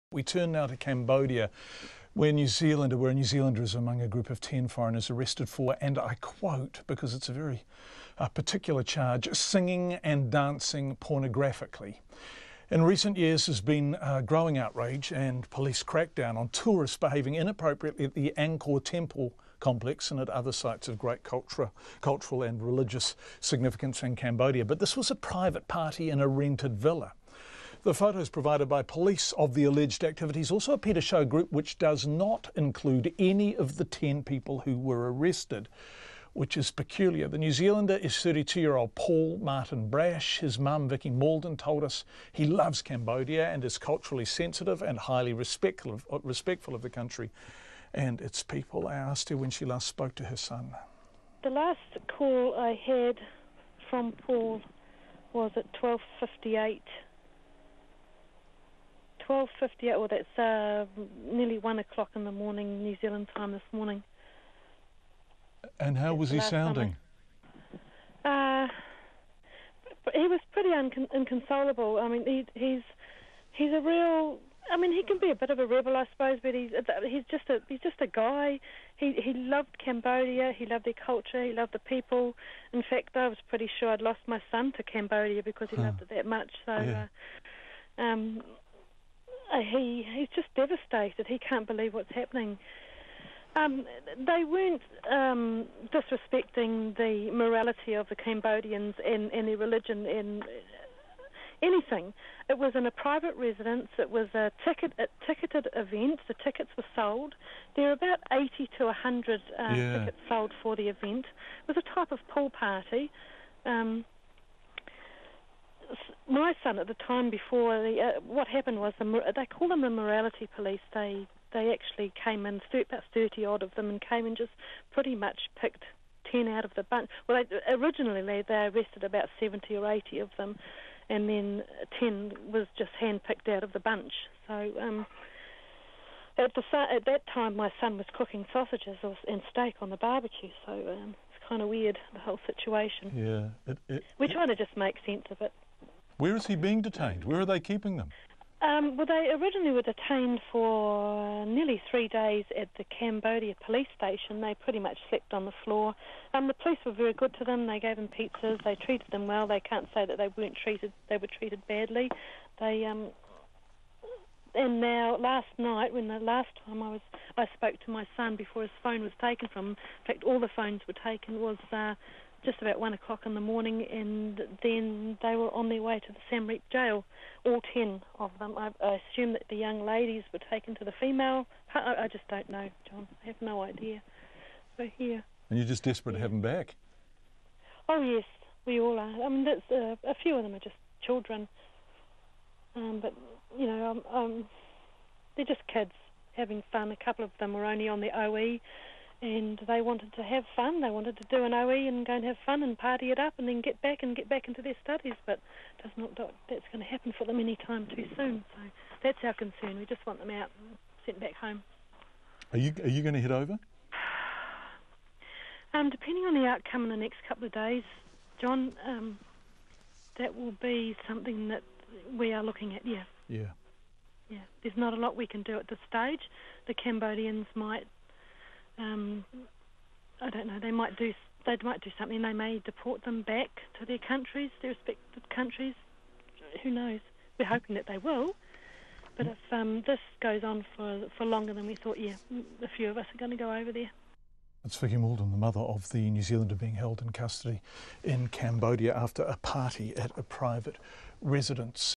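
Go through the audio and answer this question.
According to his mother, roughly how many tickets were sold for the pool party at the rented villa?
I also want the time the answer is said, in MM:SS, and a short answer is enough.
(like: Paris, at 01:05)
80 to 100, at 01:48.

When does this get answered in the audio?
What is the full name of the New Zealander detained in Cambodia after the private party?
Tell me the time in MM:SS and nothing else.
00:38.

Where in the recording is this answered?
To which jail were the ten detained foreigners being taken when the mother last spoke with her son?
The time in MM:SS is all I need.
02:56.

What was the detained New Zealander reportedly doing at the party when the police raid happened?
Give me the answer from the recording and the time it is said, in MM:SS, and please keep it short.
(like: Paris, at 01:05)
Cooking sausages and steak, at 02:18.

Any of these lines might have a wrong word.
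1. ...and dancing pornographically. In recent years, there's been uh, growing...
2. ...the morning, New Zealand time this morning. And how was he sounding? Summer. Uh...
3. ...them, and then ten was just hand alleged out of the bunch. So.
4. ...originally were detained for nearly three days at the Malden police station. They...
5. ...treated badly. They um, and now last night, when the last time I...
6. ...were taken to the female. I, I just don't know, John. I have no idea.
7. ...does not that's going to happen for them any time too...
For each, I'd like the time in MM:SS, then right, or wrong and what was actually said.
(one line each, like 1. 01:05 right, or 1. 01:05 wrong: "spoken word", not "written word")
1. 00:10 right
2. 01:02 right
3. 02:10 wrong: "picked", not "alleged"
4. 02:29 wrong: "Cambodia", not "Malden"
5. 02:41 right
6. 03:00 right
7. 03:25 right.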